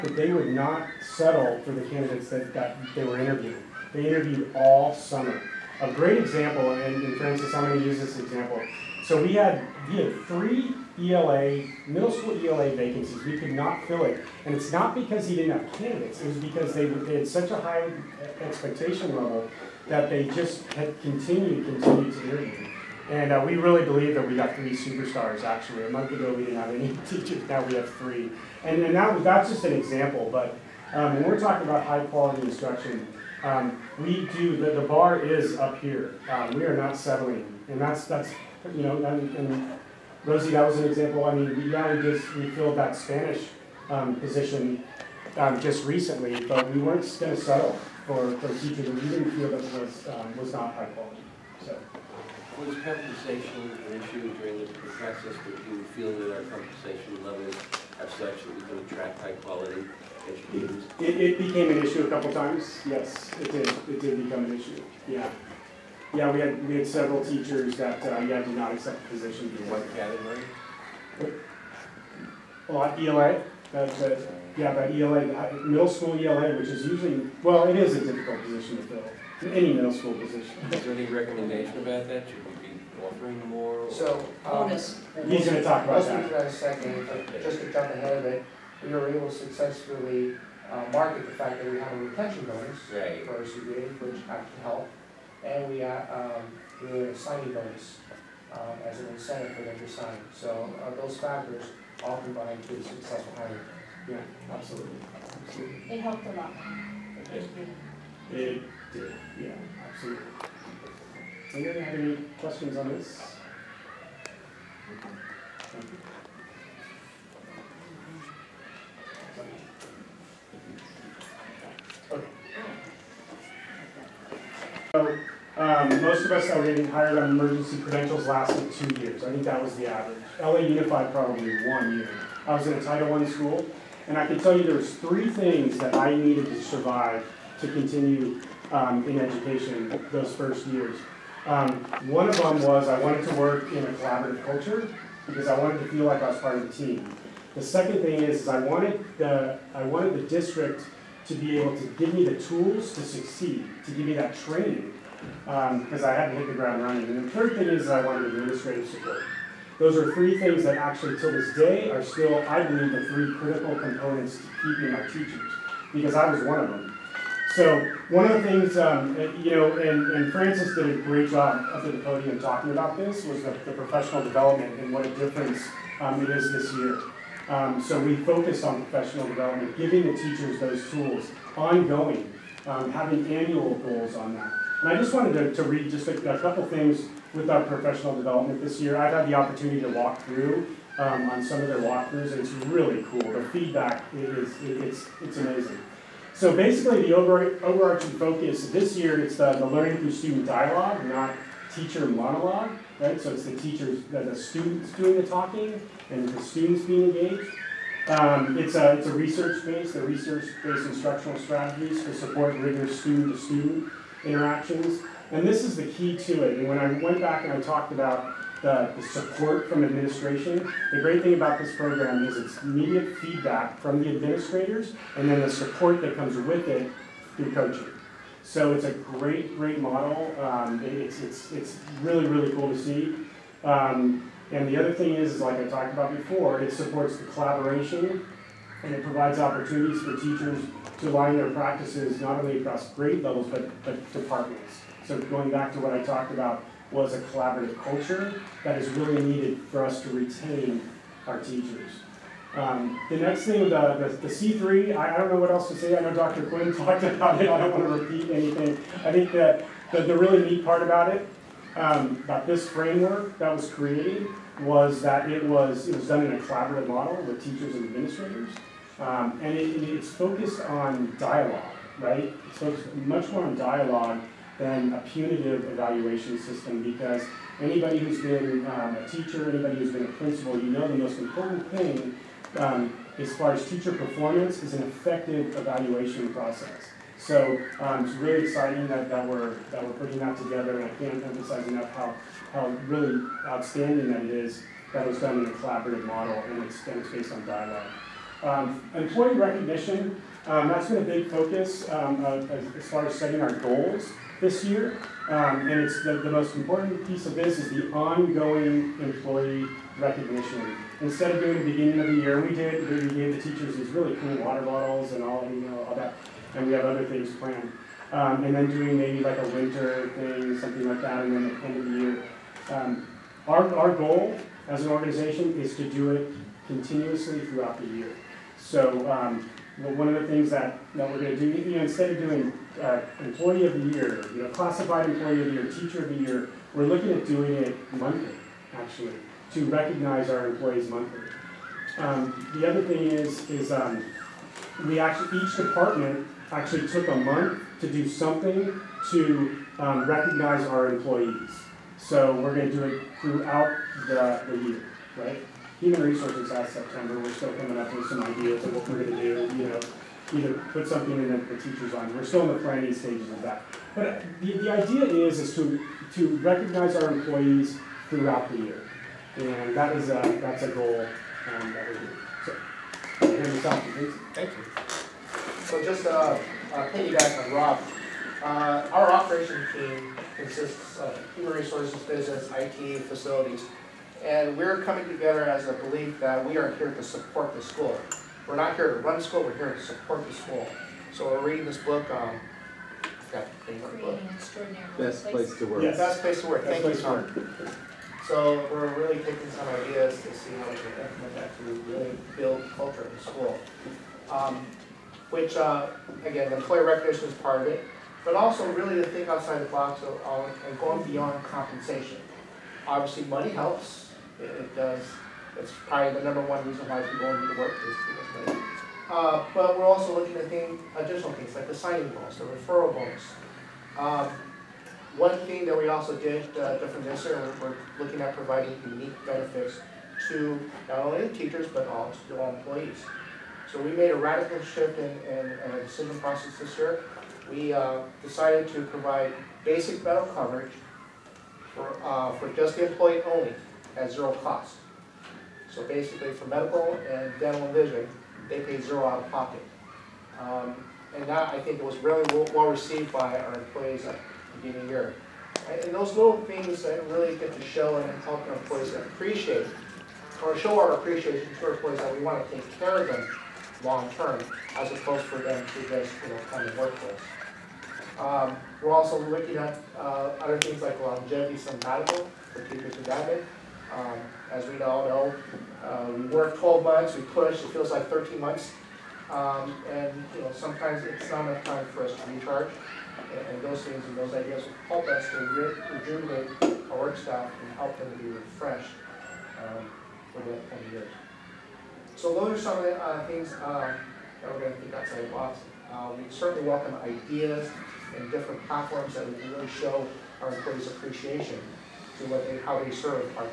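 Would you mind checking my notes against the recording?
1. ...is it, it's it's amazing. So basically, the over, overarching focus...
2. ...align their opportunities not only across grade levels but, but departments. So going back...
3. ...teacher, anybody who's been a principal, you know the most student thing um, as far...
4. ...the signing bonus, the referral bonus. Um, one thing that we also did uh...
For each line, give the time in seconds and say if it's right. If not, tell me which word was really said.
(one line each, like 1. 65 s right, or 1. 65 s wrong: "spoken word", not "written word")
1. 194 s right
2. 241 s wrong: "practices", not "opportunities"
3. 279 s wrong: "important", not "student"
4. 421 s right.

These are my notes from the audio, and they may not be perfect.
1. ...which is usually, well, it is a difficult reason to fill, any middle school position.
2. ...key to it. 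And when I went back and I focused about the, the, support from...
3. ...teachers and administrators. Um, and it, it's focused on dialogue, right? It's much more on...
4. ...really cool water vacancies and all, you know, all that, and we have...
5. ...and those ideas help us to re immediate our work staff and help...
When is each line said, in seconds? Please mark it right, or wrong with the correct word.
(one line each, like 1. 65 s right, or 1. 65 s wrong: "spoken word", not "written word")
1. 76 s wrong: "position", not "reason"
2. 215 s wrong: "talked", not "focused"
3. 267 s right
4. 313 s wrong: "bottles", not "vacancies"
5. 484 s wrong: "rejuvenate", not "immediate".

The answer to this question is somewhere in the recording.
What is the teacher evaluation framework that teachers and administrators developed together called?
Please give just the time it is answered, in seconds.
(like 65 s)
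254 s.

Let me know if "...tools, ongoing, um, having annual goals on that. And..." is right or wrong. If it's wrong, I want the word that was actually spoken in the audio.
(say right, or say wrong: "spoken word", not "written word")
right.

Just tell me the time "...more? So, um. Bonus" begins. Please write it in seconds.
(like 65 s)
83 s.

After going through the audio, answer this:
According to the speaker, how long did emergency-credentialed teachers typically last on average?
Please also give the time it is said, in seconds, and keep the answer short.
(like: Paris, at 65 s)
2 years, at 128 s.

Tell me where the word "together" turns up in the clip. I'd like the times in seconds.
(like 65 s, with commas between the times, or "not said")
290 s, 385 s.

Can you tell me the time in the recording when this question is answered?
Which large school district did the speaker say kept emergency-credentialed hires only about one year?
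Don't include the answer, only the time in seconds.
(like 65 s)
130 s.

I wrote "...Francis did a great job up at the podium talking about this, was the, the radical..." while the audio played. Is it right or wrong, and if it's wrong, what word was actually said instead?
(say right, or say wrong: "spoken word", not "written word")
wrong: "professional", not "radical".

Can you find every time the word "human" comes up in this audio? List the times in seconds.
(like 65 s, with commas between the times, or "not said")
355 s, 381 s.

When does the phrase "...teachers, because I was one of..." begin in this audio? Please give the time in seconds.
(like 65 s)
165 s.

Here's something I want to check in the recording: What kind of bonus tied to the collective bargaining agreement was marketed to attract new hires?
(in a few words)
retention bonus.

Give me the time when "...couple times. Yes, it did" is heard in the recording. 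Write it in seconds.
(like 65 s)
62 s.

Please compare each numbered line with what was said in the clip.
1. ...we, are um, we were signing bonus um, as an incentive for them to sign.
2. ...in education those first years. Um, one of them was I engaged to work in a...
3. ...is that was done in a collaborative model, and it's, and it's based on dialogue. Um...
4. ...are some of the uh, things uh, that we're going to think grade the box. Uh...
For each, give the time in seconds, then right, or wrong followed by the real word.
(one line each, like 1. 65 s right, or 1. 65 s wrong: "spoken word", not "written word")
1. 95 s right
2. 139 s wrong: "wanted", not "engaged"
3. 294 s right
4. 492 s wrong: "outside", not "grade".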